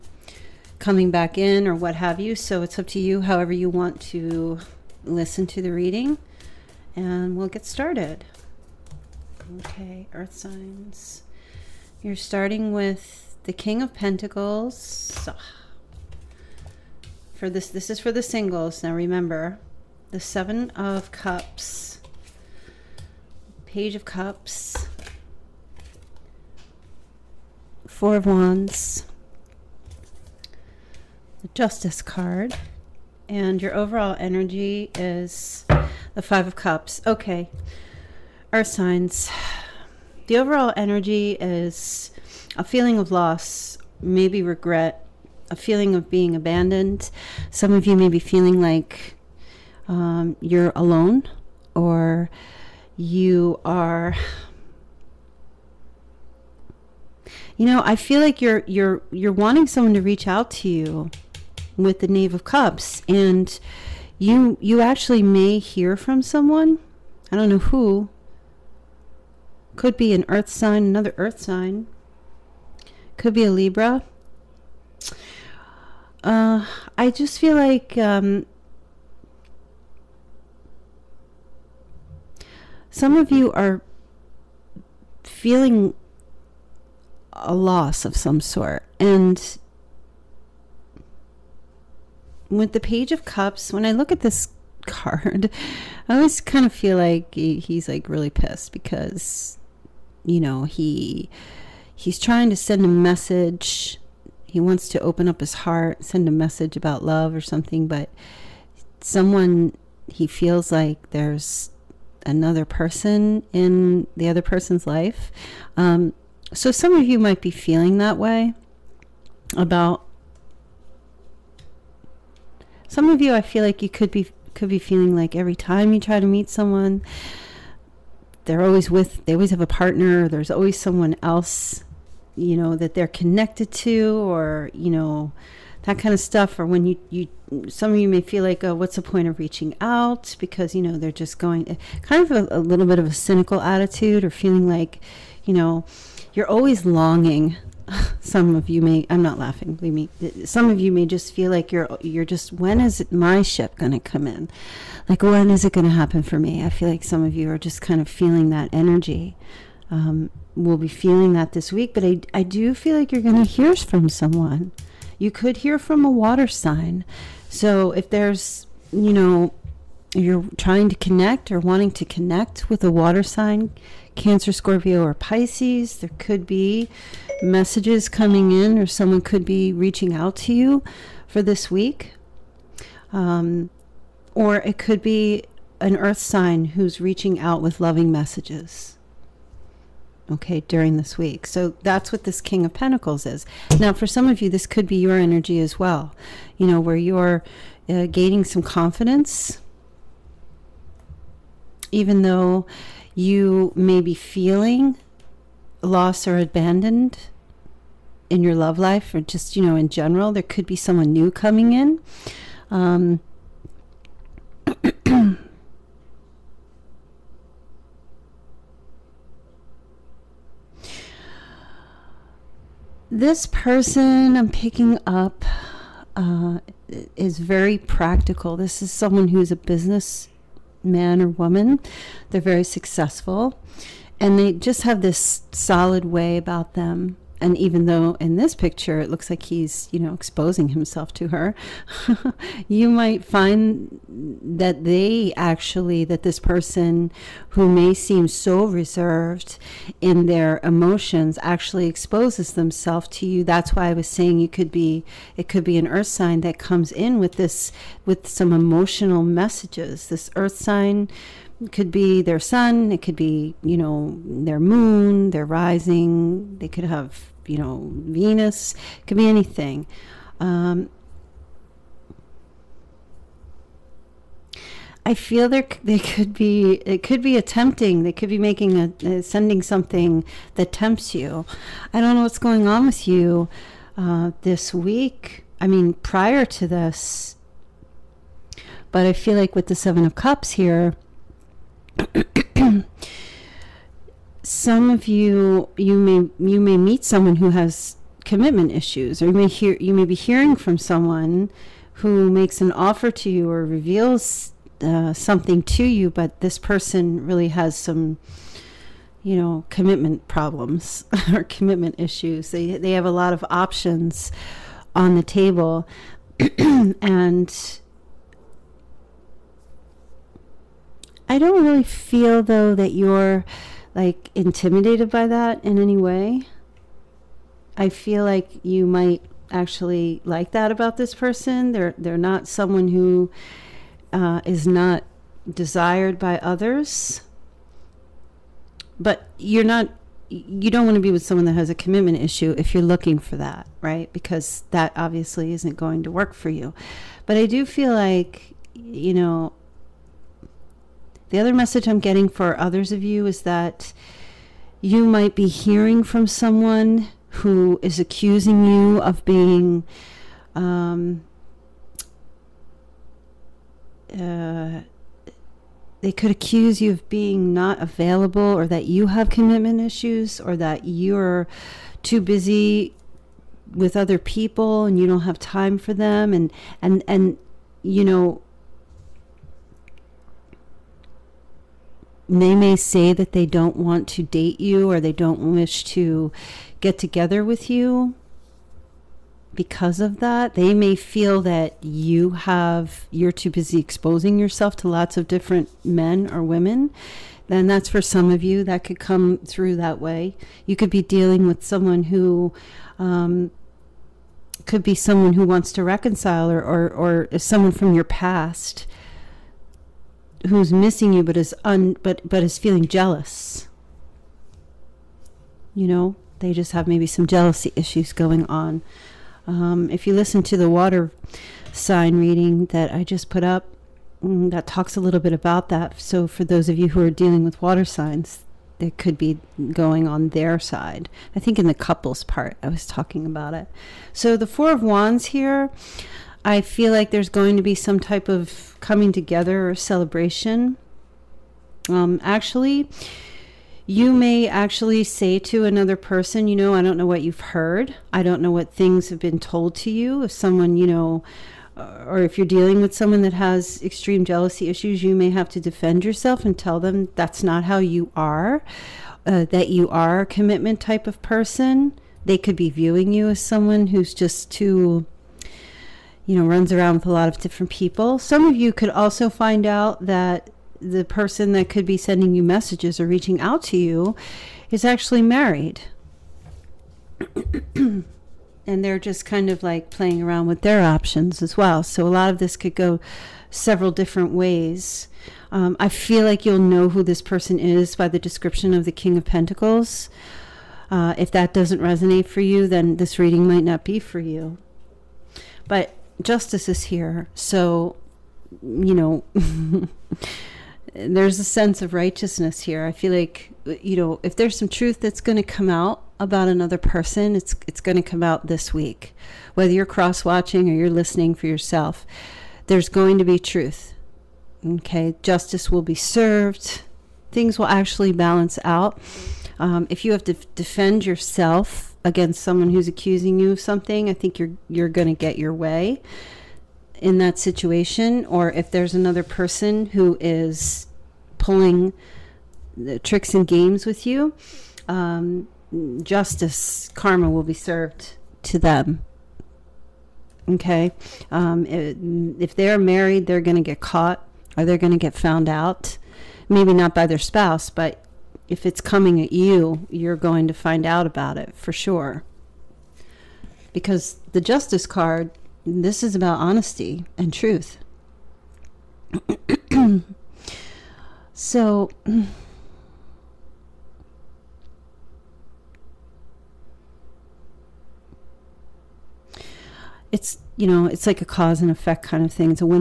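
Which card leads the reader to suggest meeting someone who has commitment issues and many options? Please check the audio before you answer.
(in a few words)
Seven of Cups.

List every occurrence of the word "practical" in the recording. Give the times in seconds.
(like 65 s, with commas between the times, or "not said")
227 s.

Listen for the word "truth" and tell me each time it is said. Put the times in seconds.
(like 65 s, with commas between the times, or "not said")
504 s, 513 s, 557 s.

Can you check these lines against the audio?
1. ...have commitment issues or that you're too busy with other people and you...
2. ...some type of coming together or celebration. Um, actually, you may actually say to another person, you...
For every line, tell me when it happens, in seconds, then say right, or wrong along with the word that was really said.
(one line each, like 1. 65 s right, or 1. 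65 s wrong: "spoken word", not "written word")
1. 369 s right
2. 437 s right.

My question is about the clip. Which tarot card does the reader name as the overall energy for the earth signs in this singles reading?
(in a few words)
Five of Cups.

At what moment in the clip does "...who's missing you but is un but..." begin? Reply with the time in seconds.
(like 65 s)
410 s.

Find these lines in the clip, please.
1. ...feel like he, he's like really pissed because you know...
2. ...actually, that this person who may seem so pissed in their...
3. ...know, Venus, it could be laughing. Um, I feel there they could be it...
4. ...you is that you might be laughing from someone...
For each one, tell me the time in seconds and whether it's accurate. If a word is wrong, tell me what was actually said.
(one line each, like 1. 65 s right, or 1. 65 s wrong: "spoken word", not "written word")
1. 96 s right
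2. 245 s wrong: "reserved", not "pissed"
3. 267 s wrong: "anything", not "laughing"
4. 353 s wrong: "hearing", not "laughing".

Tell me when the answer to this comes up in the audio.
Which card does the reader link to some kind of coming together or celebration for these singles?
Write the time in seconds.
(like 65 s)
434 s.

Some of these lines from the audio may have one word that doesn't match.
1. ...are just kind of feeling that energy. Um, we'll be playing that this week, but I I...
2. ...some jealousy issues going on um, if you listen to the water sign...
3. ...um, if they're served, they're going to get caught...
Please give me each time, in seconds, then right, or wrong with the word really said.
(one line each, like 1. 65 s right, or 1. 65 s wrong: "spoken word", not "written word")
1. 157 s wrong: "feeling", not "playing"
2. 417 s right
3. 541 s wrong: "married", not "served".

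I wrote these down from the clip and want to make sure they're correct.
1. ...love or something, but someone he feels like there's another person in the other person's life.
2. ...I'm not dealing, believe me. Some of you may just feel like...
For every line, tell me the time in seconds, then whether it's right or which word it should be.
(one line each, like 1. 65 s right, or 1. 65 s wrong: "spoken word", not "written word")
1. 107 s right
2. 149 s wrong: "laughing", not "dealing".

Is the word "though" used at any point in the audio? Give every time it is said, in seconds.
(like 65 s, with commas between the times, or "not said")
202 s, 237 s, 322 s.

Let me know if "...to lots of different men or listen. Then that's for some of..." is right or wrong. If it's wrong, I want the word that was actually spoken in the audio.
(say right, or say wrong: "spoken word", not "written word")
wrong: "women", not "listen".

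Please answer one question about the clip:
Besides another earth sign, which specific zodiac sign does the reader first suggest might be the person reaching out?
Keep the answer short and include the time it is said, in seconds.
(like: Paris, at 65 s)
Libra, at 73 s.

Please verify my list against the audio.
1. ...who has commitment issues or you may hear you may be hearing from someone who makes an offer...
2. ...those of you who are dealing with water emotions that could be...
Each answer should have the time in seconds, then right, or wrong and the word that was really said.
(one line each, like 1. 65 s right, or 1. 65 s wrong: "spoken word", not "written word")
1. 297 s right
2. 426 s wrong: "signs", not "emotions".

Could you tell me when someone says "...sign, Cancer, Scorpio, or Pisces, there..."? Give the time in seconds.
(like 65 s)
173 s.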